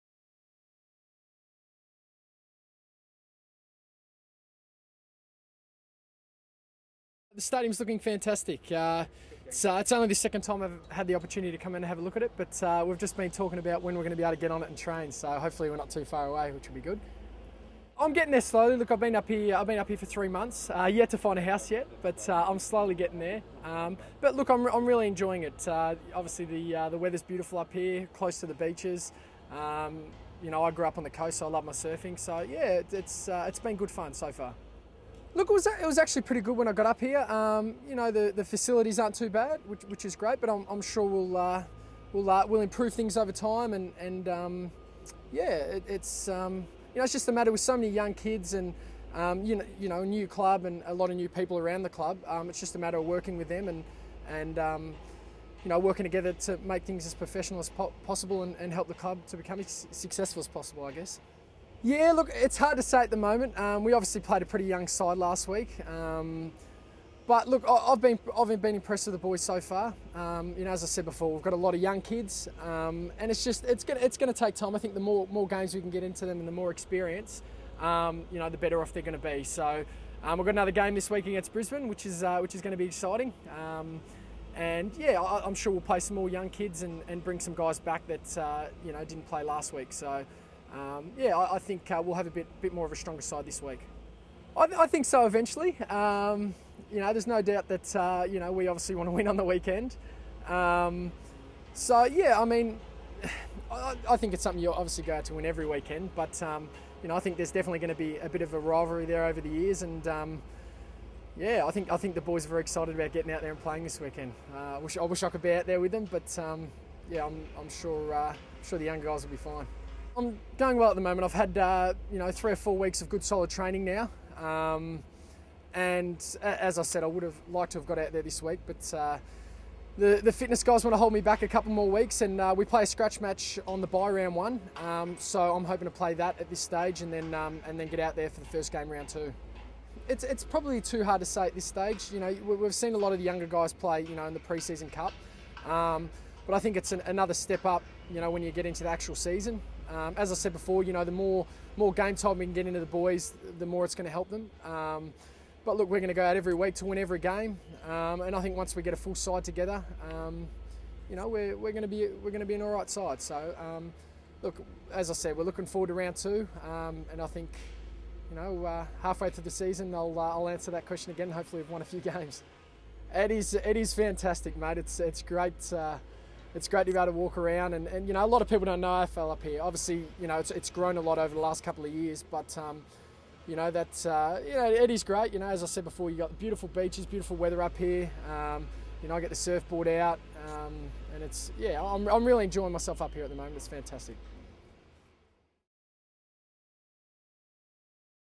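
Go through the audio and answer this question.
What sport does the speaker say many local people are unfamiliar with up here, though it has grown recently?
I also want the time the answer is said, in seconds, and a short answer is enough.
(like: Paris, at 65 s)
AFL, at 178 s.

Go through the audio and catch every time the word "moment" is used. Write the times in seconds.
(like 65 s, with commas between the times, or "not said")
63 s, 121 s, 193 s.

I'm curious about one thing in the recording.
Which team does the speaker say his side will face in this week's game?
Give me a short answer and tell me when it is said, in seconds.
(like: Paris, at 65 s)
Brisbane, at 81 s.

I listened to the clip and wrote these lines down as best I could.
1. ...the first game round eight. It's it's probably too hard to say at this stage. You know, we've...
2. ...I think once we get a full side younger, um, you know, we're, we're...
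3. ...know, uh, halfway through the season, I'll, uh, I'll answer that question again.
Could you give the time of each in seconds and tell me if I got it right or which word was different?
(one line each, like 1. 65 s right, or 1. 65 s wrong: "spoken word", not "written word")
1. 138 s wrong: "two", not "eight"
2. 158 s wrong: "together", not "younger"
3. 168 s right.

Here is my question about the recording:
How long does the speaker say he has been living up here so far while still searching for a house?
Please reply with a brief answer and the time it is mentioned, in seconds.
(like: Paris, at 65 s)
3 months, at 20 s.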